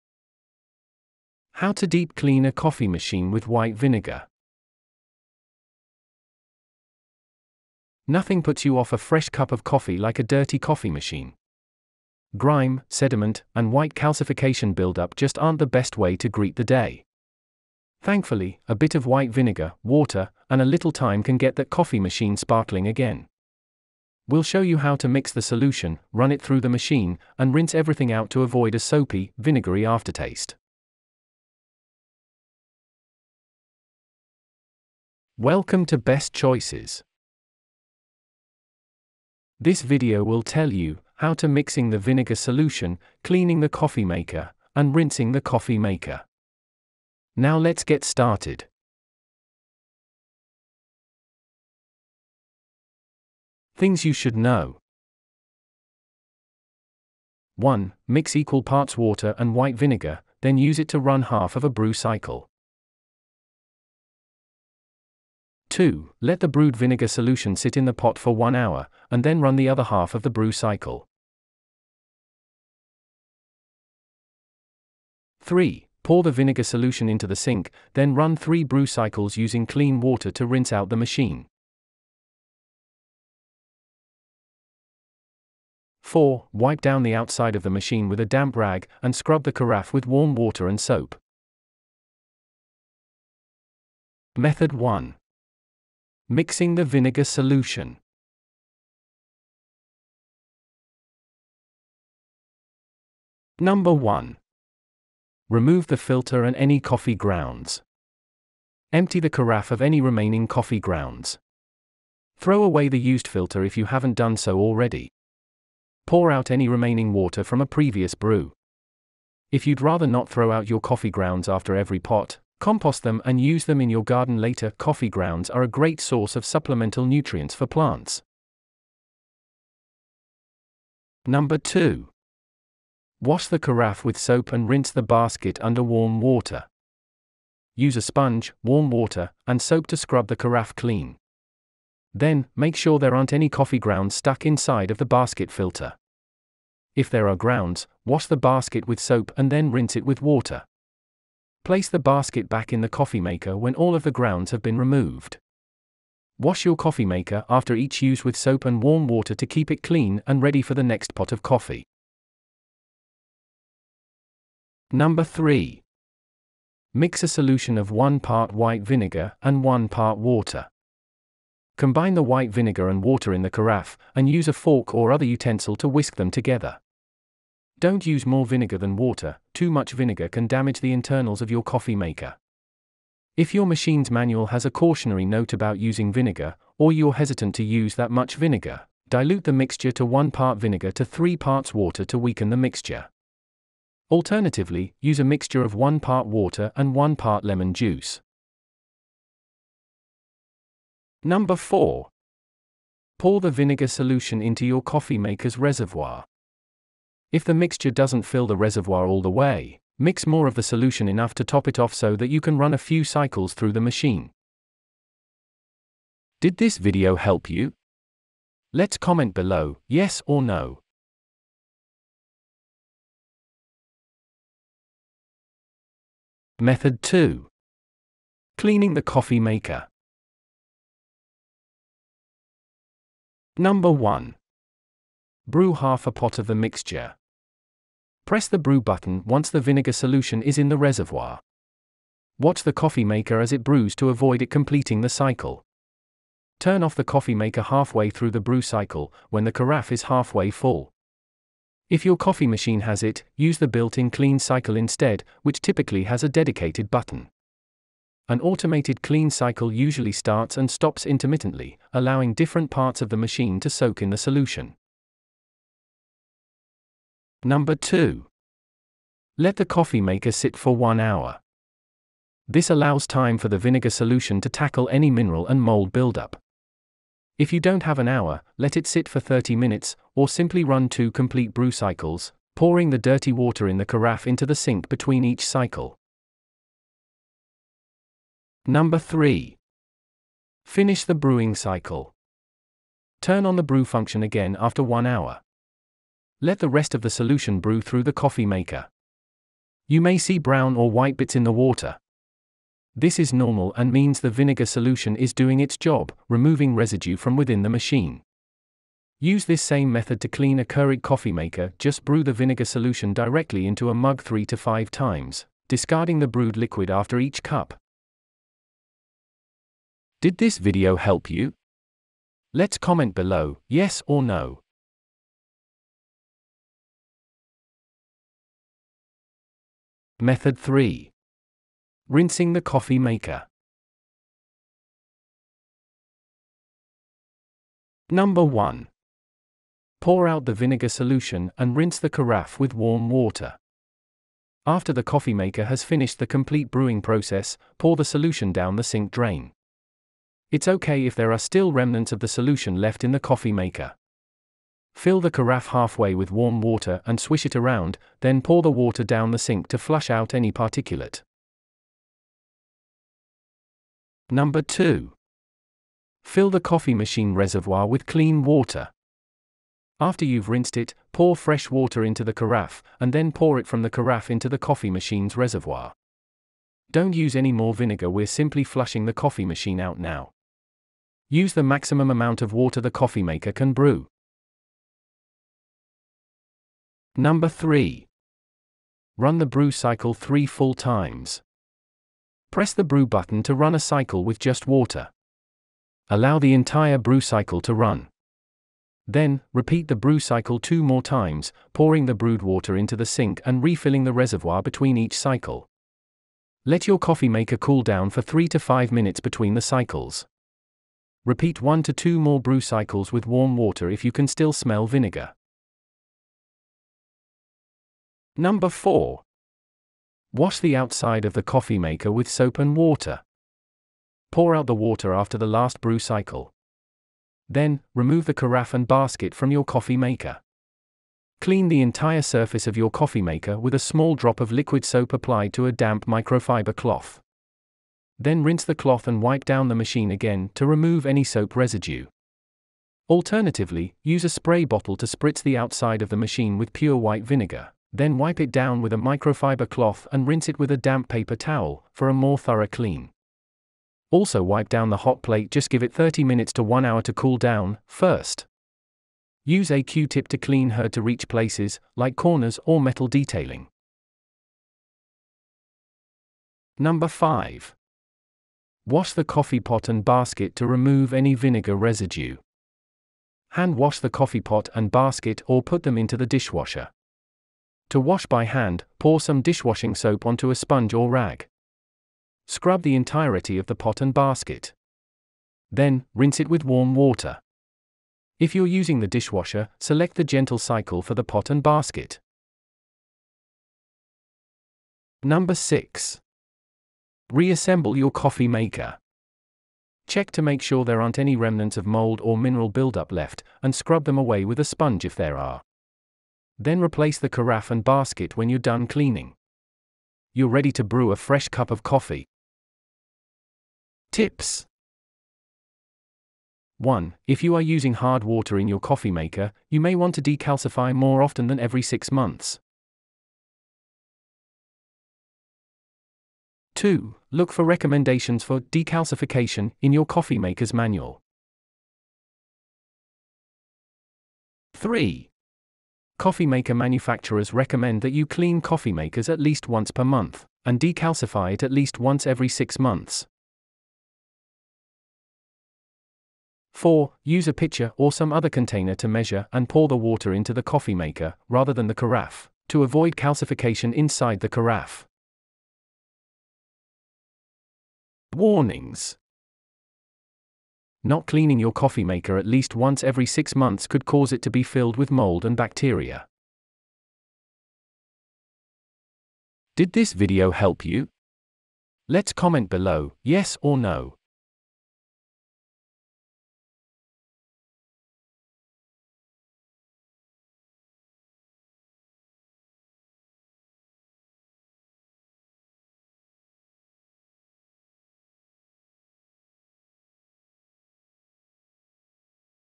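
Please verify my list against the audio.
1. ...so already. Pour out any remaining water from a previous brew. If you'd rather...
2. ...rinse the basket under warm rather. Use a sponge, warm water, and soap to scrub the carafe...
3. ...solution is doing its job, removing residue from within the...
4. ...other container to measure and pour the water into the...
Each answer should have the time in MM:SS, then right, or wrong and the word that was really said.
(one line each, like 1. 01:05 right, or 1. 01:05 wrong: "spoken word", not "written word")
1. 01:54 right
2. 02:14 wrong: "water", not "rather"
3. 05:04 right
4. 09:08 right.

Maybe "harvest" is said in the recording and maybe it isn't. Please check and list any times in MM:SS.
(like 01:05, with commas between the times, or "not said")
not said.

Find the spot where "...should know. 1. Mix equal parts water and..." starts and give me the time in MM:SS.
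00:54.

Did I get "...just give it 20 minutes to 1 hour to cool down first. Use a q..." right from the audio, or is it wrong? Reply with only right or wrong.
wrong.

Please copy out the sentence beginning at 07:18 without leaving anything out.
Then rinse the cloth and wipe down the machine again to remove any soap residue.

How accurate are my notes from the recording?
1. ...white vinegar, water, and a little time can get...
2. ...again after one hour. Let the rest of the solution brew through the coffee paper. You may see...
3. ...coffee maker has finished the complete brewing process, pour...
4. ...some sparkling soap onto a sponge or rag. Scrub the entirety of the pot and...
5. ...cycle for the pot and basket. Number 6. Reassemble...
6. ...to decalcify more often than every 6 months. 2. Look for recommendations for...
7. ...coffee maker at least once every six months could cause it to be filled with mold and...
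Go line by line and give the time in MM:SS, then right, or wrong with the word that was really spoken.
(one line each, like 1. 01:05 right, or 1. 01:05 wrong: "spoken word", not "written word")
1. 00:19 right
2. 04:54 wrong: "maker", not "paper"
3. 05:45 right
4. 07:59 wrong: "dishwashing", not "sparkling"
5. 08:10 right
6. 08:40 right
7. 09:21 right.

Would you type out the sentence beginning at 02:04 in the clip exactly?
Coffee grounds are a great source of supplemental nutrients for plants.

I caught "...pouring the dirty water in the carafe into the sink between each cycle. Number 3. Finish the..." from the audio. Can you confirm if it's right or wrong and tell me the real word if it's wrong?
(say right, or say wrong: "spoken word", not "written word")
right.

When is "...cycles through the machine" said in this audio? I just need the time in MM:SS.
03:33.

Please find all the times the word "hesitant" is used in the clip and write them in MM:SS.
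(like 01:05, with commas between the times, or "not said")
03:07.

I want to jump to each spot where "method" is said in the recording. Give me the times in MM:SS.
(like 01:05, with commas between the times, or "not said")
01:34, 03:46, 05:09, 05:30.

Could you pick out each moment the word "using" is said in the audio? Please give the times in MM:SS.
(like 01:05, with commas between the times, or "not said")
01:19, 03:05, 08:08, 08:37.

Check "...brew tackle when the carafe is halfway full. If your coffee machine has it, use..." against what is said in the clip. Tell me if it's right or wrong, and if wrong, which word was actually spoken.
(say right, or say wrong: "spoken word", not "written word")
wrong: "cycle", not "tackle".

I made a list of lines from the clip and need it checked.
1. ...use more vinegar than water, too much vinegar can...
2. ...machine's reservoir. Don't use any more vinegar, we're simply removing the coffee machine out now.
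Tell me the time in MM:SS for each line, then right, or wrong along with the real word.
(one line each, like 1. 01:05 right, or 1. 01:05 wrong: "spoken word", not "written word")
1. 02:58 right
2. 06:14 wrong: "flushing", not "removing".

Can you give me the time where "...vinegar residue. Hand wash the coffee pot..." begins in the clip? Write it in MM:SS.
07:51.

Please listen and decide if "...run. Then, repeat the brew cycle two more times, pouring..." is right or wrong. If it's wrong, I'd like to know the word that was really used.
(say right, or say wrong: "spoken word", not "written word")
right.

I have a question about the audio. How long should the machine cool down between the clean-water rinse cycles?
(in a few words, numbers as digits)
3 to 5 minutes.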